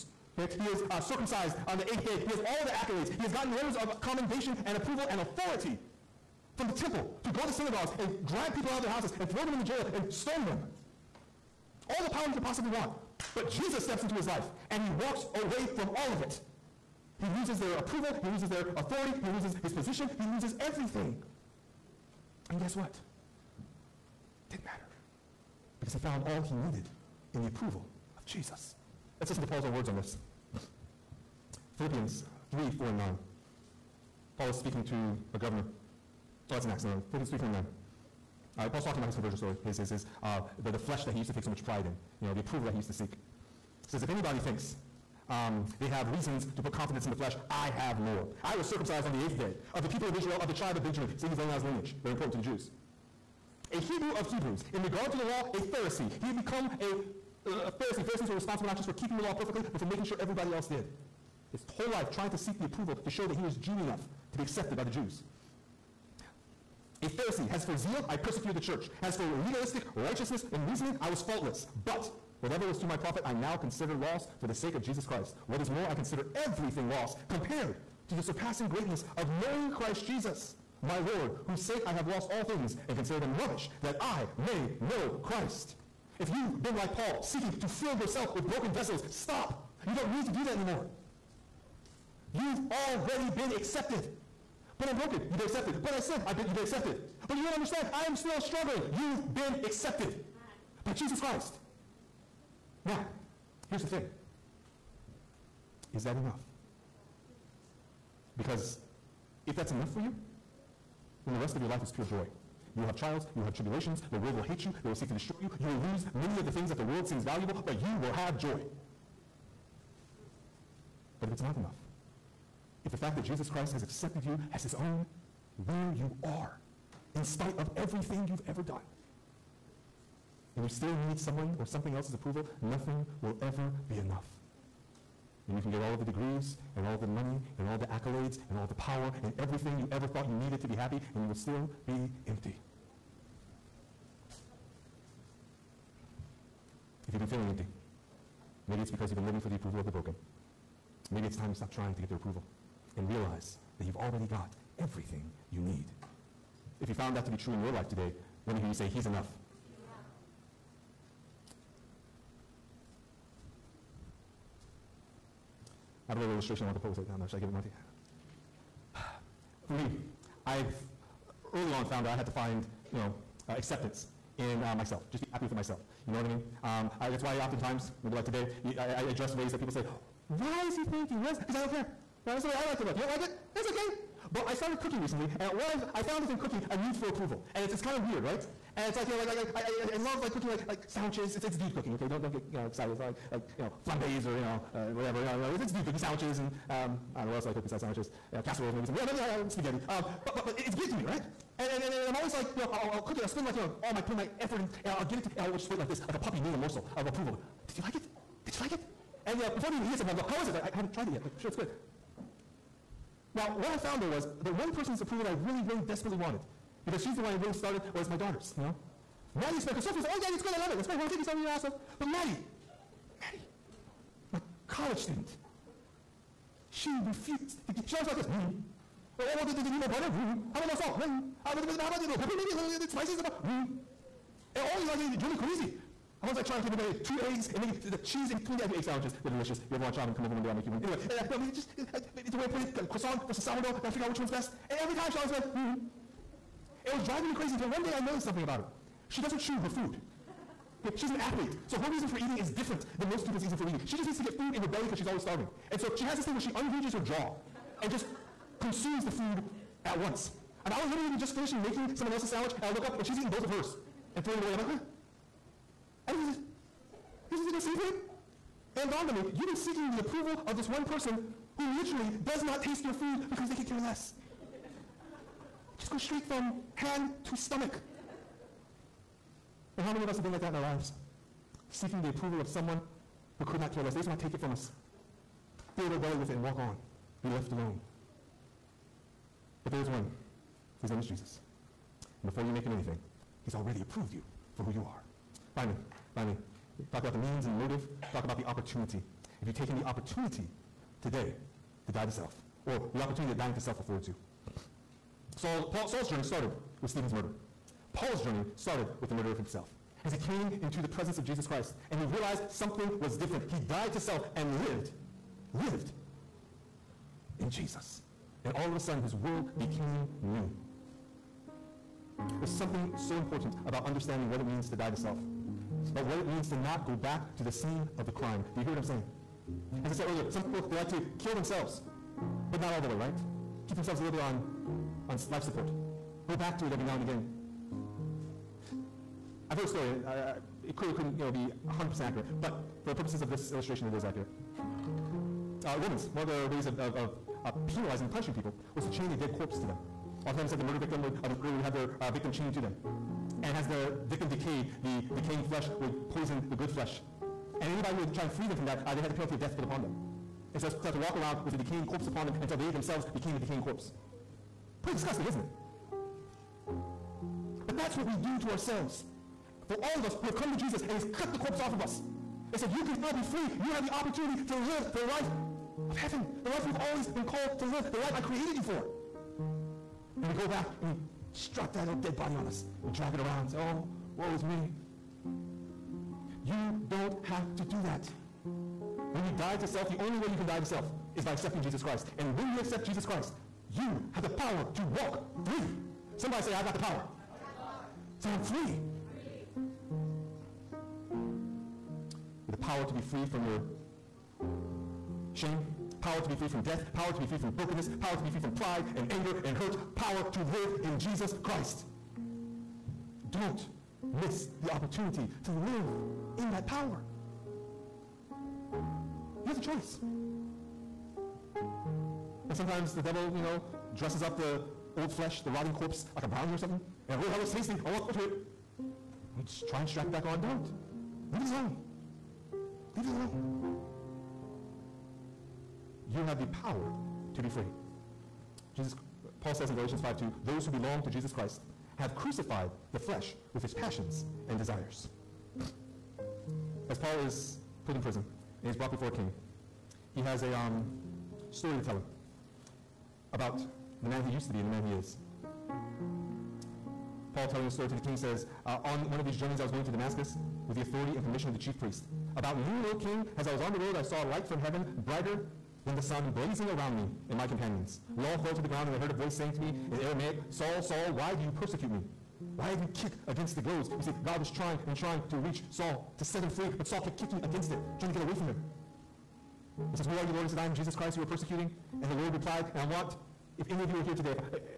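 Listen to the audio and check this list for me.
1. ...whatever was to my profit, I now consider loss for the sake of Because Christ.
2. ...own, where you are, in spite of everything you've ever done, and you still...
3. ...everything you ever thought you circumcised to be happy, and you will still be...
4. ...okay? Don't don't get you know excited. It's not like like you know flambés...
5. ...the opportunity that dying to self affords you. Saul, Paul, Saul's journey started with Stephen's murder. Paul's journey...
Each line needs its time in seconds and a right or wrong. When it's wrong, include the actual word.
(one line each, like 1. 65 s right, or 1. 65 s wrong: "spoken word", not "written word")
1. 72 s wrong: "Jesus", not "Because"
2. 124 s right
3. 139 s wrong: "needed", not "circumcised"
4. 191 s right
5. 302 s right.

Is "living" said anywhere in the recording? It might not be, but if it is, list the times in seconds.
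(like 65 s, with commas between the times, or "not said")
149 s.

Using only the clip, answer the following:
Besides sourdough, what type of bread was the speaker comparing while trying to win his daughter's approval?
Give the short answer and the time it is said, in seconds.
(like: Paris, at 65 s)
Croissant, at 242 s.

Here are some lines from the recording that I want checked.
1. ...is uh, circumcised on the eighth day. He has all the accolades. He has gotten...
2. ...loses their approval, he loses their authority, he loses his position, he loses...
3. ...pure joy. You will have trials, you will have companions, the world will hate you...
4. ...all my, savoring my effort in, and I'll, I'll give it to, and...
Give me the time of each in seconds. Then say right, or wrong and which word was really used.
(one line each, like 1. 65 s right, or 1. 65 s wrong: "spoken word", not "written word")
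1. 0 s right
2. 17 s right
3. 111 s wrong: "tribulations", not "companions"
4. 203 s wrong: "putting", not "savoring".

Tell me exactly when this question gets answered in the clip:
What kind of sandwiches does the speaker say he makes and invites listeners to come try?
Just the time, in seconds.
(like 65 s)
238 s.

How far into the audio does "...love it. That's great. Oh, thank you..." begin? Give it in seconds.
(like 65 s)
220 s.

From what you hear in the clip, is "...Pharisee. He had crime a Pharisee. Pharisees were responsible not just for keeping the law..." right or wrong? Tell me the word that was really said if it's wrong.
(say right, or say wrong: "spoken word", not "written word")
wrong: "become", not "crime".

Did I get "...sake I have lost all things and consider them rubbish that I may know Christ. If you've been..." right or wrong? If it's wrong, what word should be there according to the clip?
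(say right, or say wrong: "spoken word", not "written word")
right.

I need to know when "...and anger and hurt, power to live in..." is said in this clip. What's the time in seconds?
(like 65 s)
408 s.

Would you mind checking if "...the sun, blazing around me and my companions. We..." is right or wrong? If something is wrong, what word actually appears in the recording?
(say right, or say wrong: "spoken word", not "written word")
right.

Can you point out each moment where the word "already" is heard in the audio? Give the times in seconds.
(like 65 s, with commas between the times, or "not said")
92 s, 153 s, 293 s.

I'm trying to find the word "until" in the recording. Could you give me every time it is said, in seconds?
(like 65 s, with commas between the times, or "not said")
247 s, 362 s.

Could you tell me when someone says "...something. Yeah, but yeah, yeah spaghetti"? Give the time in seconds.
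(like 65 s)
198 s.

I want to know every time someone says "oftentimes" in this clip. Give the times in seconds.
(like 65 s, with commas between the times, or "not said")
177 s, 350 s.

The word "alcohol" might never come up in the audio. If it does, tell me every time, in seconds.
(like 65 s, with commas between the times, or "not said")
not said.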